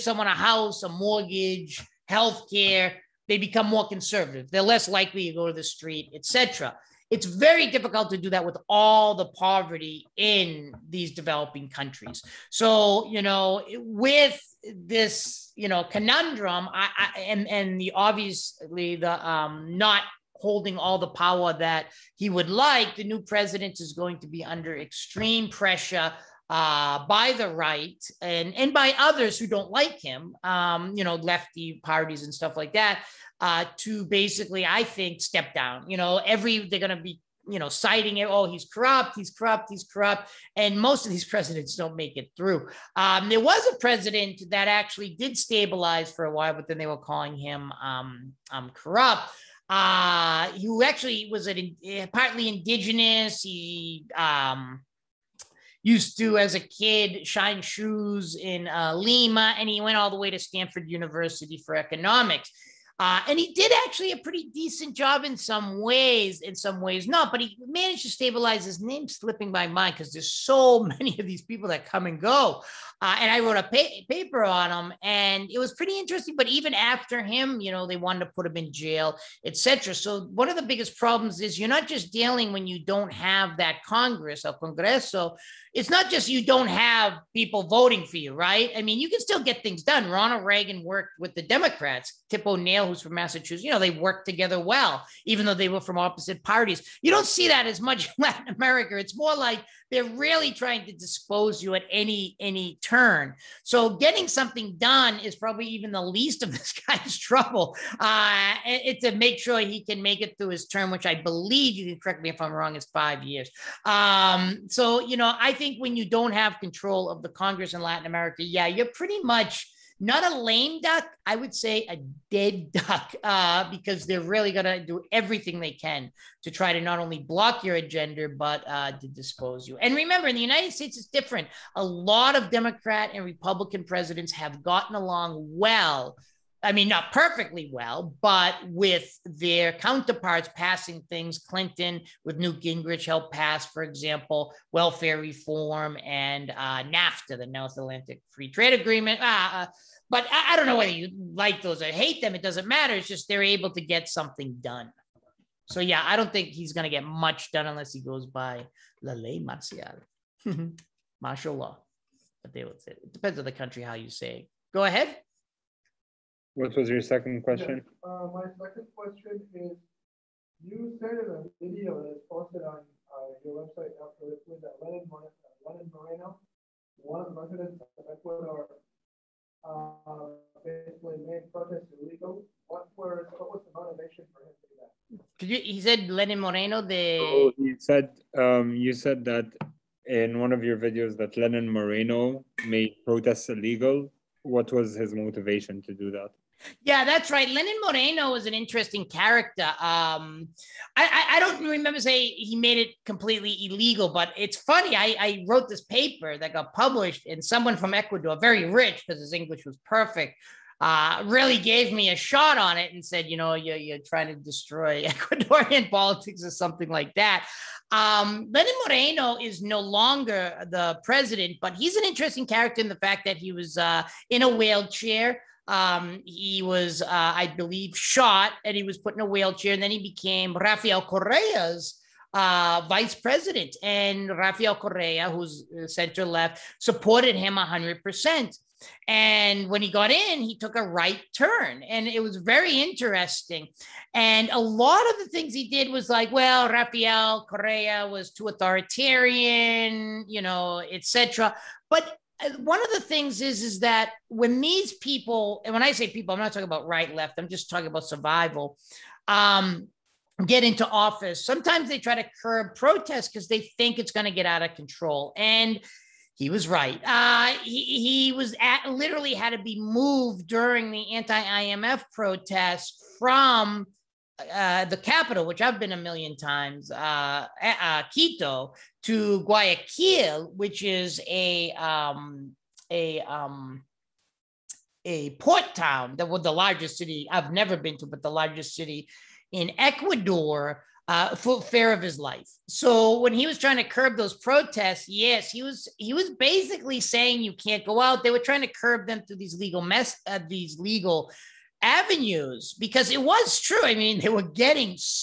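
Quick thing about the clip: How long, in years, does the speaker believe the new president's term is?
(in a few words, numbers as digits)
5.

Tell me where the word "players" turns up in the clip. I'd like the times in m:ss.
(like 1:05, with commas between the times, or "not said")
not said.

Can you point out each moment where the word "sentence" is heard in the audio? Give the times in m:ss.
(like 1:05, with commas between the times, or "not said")
not said.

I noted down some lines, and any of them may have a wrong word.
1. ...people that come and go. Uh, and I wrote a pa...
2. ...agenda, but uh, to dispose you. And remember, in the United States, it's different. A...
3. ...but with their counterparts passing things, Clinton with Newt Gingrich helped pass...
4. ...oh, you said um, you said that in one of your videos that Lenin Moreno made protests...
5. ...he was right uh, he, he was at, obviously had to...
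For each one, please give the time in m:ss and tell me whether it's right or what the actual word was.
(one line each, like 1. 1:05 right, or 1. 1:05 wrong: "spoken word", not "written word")
1. 1:11 right
2. 2:07 right
3. 2:18 right
4. 3:07 right
5. 4:26 wrong: "literally", not "obviously".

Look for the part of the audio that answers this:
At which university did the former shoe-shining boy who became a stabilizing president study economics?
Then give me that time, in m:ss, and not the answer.
1:00.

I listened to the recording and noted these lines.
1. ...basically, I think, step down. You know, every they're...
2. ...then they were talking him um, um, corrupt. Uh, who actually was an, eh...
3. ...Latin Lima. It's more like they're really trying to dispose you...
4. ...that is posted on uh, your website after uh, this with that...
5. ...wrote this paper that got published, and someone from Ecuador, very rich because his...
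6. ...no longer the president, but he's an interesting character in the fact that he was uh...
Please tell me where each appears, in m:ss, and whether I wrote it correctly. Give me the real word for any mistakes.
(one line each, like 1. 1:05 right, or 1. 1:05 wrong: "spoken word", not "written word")
1. 0:34 right
2. 0:46 wrong: "calling", not "talking"
3. 1:38 wrong: "America", not "Lima"
4. 2:52 right
5. 3:25 right
6. 3:39 right.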